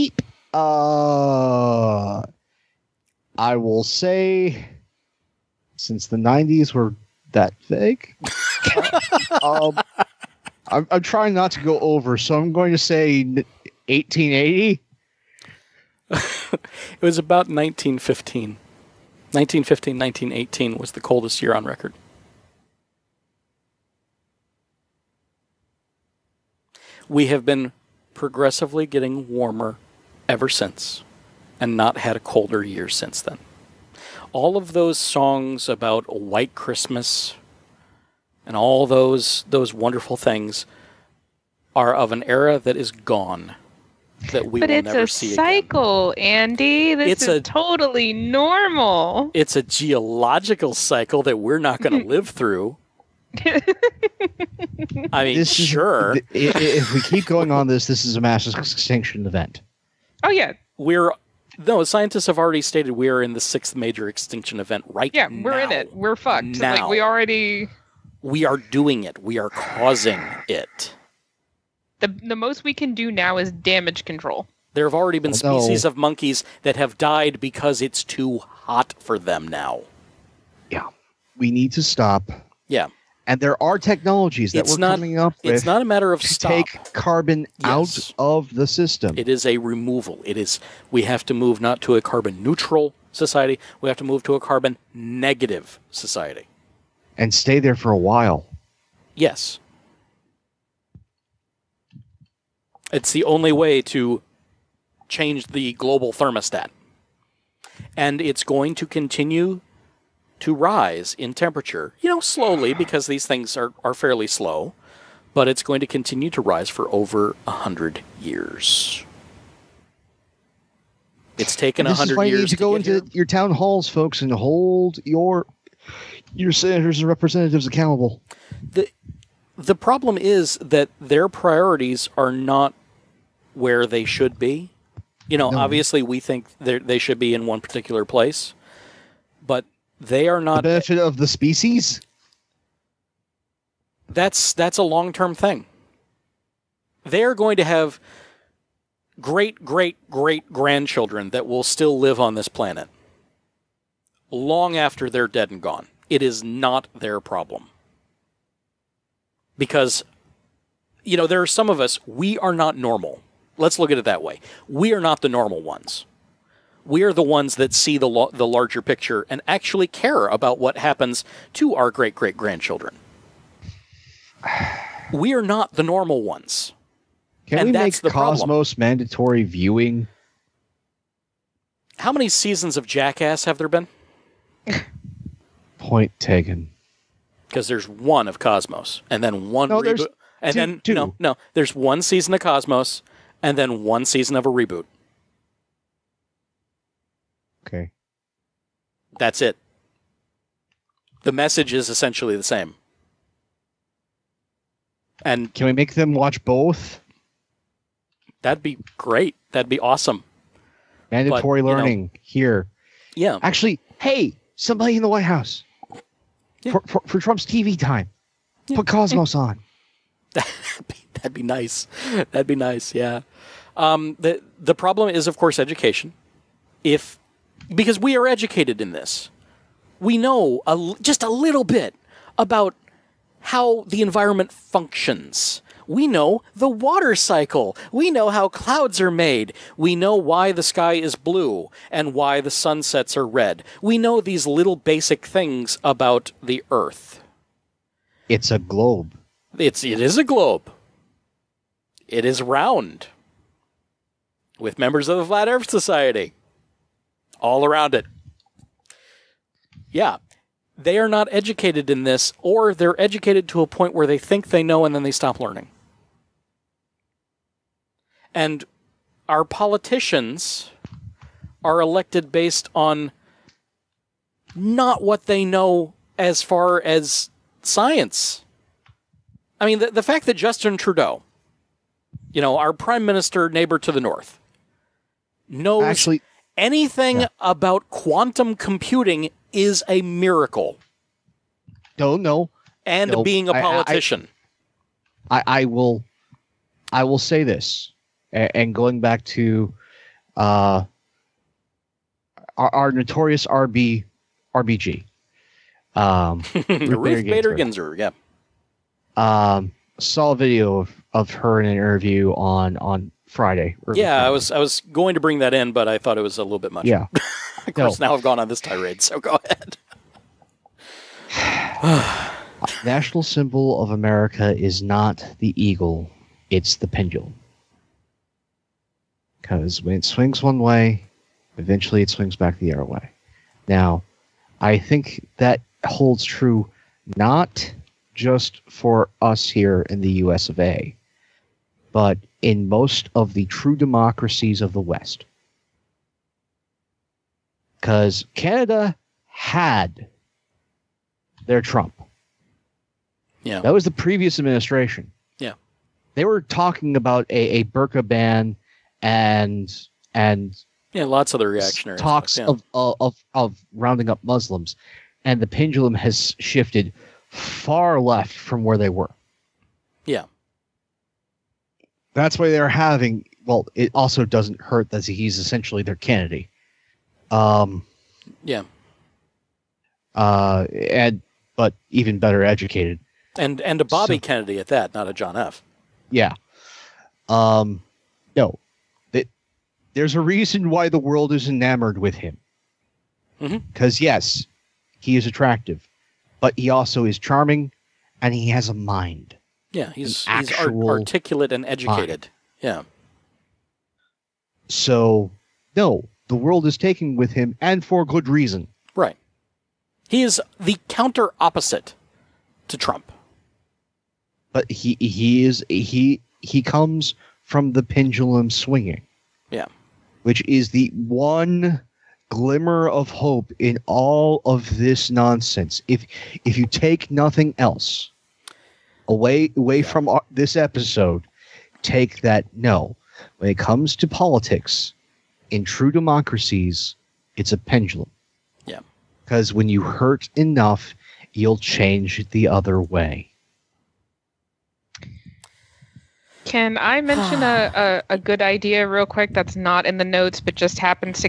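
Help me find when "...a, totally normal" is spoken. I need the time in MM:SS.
00:47.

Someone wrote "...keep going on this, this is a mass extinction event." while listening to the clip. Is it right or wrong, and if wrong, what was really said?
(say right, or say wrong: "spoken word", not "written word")
right.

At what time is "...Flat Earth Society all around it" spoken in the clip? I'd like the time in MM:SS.
04:15.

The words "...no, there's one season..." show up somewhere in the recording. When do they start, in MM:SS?
03:11.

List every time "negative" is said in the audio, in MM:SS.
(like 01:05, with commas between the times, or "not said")
01:34.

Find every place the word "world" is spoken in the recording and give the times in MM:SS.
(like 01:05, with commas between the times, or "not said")
06:30, 06:46.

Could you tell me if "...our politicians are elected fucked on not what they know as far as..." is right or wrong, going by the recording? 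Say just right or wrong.
wrong.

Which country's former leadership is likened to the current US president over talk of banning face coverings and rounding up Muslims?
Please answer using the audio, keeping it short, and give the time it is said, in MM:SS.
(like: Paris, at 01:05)
Canada, at 05:48.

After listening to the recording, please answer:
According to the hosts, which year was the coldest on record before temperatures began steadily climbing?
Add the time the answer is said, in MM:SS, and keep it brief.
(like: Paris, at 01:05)
1918, at 00:19.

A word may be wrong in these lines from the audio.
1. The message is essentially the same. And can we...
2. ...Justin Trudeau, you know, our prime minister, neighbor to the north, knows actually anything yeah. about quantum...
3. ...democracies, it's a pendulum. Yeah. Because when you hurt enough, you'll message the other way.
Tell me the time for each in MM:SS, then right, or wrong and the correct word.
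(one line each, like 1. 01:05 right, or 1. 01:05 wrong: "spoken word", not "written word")
1. 03:21 right
2. 04:40 right
3. 07:15 wrong: "change", not "message".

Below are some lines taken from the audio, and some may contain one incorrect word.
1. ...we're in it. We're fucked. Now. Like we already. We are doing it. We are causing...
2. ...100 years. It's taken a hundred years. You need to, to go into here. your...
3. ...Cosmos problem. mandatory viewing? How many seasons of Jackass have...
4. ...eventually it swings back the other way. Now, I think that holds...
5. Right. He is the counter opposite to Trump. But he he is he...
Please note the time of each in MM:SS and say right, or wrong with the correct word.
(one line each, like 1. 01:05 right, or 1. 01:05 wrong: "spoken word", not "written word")
1. 01:05 right
2. 01:57 right
3. 02:58 right
4. 05:31 right
5. 06:48 right.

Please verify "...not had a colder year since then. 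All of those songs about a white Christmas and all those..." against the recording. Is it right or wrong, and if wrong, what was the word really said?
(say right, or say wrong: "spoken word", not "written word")
right.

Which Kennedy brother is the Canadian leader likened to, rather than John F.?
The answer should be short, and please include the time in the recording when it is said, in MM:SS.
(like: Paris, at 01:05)
Bobby, at 06:23.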